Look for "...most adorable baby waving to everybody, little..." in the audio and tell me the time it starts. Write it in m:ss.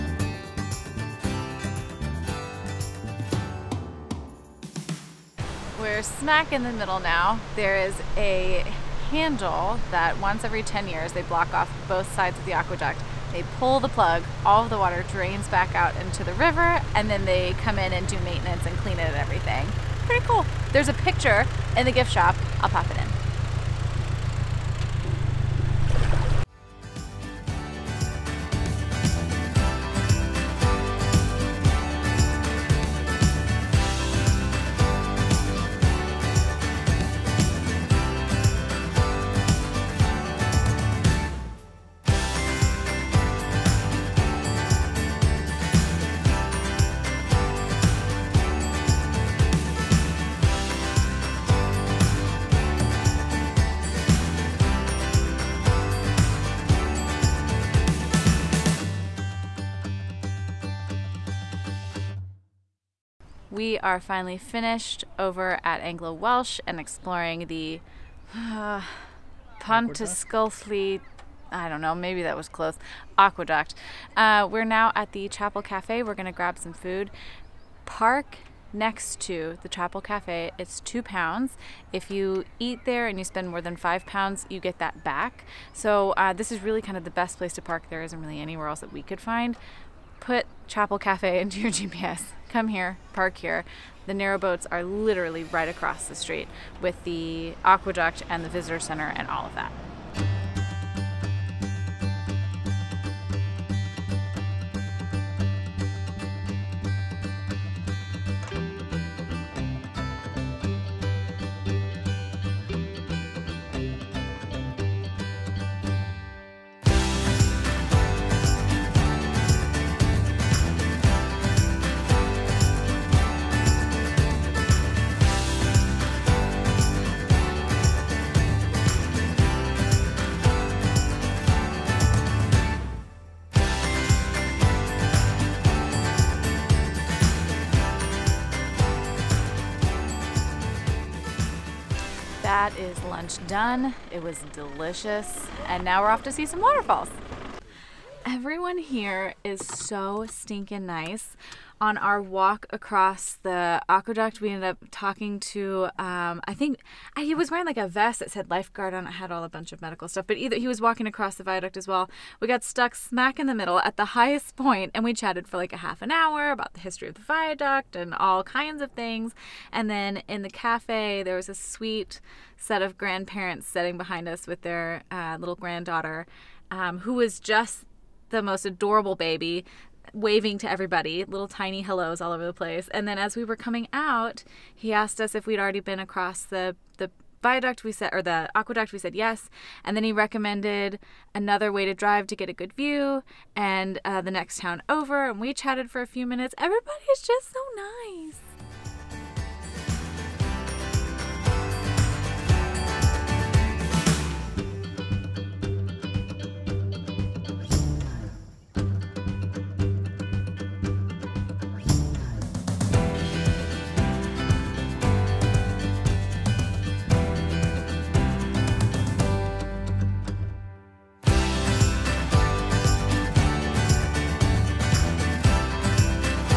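2:58.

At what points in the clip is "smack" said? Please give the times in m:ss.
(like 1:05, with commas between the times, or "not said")
0:06, 2:42.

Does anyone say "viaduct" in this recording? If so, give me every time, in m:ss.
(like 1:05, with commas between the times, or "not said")
2:41, 2:47, 3:07.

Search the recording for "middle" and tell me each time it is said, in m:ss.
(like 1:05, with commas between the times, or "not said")
0:06, 2:43.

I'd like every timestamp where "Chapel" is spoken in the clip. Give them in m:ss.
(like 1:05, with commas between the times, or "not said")
1:15, 1:19, 1:30.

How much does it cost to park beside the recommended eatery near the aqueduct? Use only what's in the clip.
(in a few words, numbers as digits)
£2.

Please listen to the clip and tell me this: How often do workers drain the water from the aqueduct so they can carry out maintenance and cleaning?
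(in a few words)
Every 10 years.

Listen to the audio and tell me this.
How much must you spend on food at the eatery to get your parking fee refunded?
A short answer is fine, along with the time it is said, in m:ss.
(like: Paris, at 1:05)
More than £5, at 1:23.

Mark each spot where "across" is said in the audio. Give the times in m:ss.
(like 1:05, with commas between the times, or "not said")
1:35, 2:32, 2:41, 3:05.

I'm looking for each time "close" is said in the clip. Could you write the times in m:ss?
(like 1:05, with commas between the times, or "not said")
1:12.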